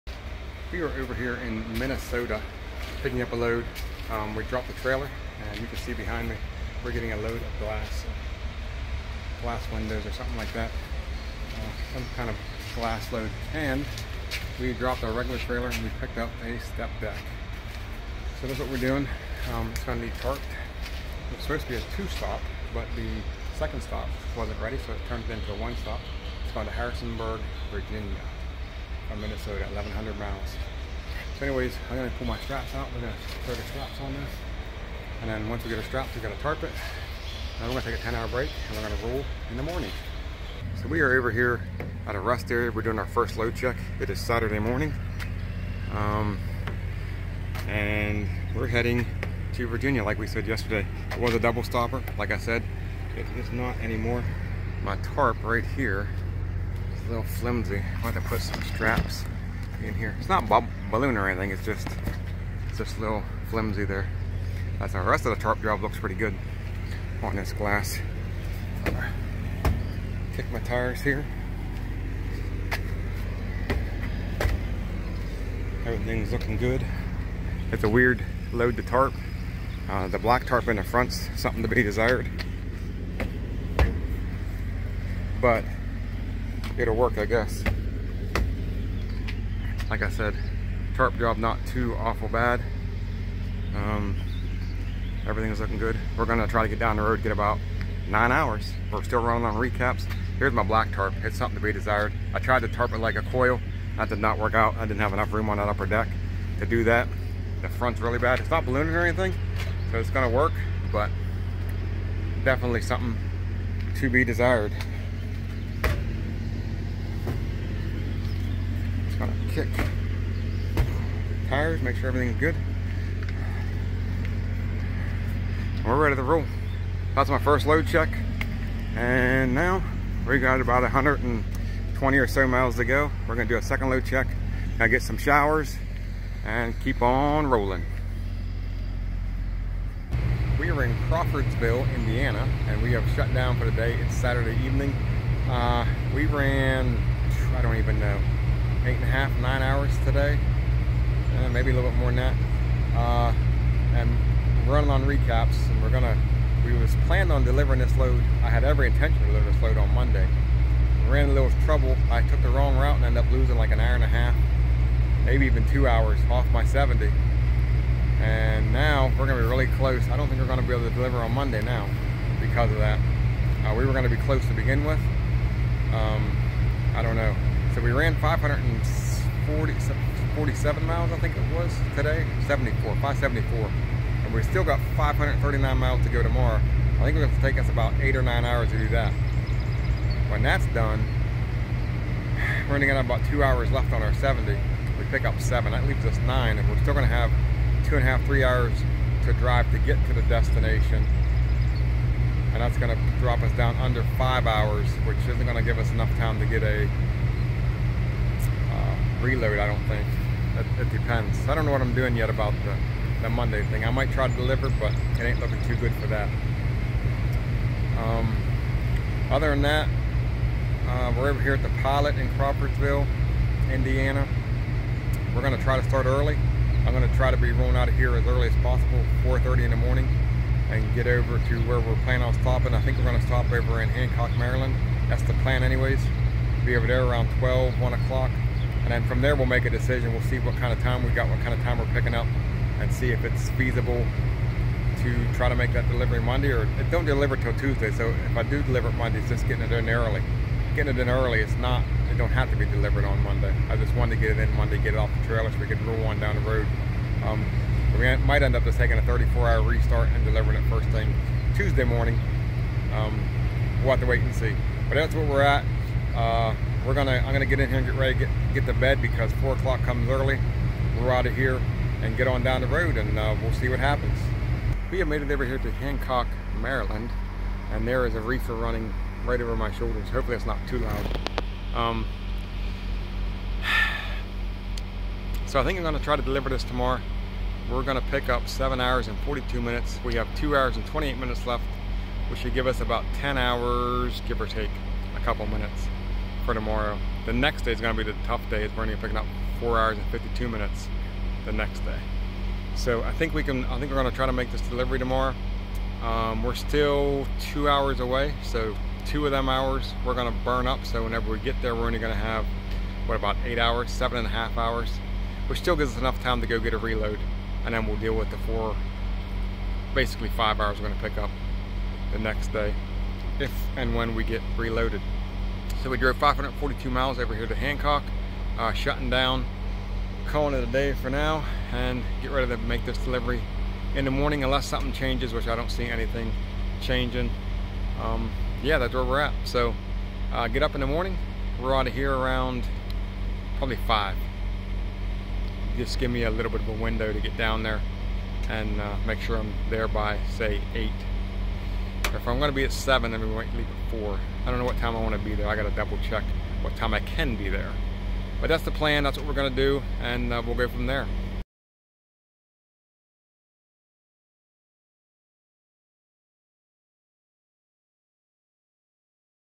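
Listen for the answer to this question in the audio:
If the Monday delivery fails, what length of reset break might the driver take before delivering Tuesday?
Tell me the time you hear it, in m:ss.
4:19.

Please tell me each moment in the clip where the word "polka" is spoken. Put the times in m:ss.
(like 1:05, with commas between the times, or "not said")
not said.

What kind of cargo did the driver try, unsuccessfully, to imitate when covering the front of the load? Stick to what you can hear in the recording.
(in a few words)
A coil.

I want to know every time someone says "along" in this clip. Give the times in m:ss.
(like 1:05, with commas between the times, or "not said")
not said.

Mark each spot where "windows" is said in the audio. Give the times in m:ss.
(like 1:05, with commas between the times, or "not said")
0:09, 5:46.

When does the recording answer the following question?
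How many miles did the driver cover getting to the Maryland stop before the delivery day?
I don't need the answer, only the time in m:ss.
5:26.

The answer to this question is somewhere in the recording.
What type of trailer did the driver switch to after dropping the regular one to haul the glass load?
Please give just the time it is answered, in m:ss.
0:16.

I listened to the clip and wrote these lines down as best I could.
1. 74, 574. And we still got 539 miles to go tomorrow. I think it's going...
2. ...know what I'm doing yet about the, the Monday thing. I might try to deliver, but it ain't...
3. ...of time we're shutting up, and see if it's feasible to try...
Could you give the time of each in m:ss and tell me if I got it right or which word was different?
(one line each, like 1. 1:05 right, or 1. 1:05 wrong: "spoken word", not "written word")
1. 3:02 right
2. 3:31 right
3. 4:01 wrong: "picking", not "shutting".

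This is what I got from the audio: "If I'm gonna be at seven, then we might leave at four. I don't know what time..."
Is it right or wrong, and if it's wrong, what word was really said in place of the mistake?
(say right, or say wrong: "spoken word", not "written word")
right.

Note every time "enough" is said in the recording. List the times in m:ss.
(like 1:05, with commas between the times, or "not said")
1:45, 3:25, 5:15.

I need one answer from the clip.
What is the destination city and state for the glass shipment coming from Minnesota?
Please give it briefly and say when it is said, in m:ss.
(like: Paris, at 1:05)
Harrisonburg, Virginia, at 0:26.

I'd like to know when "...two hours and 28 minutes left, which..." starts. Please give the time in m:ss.
4:50.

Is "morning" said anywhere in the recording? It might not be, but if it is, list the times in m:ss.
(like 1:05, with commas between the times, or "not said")
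0:39, 0:44, 3:49, 4:21, 5:34, 5:40.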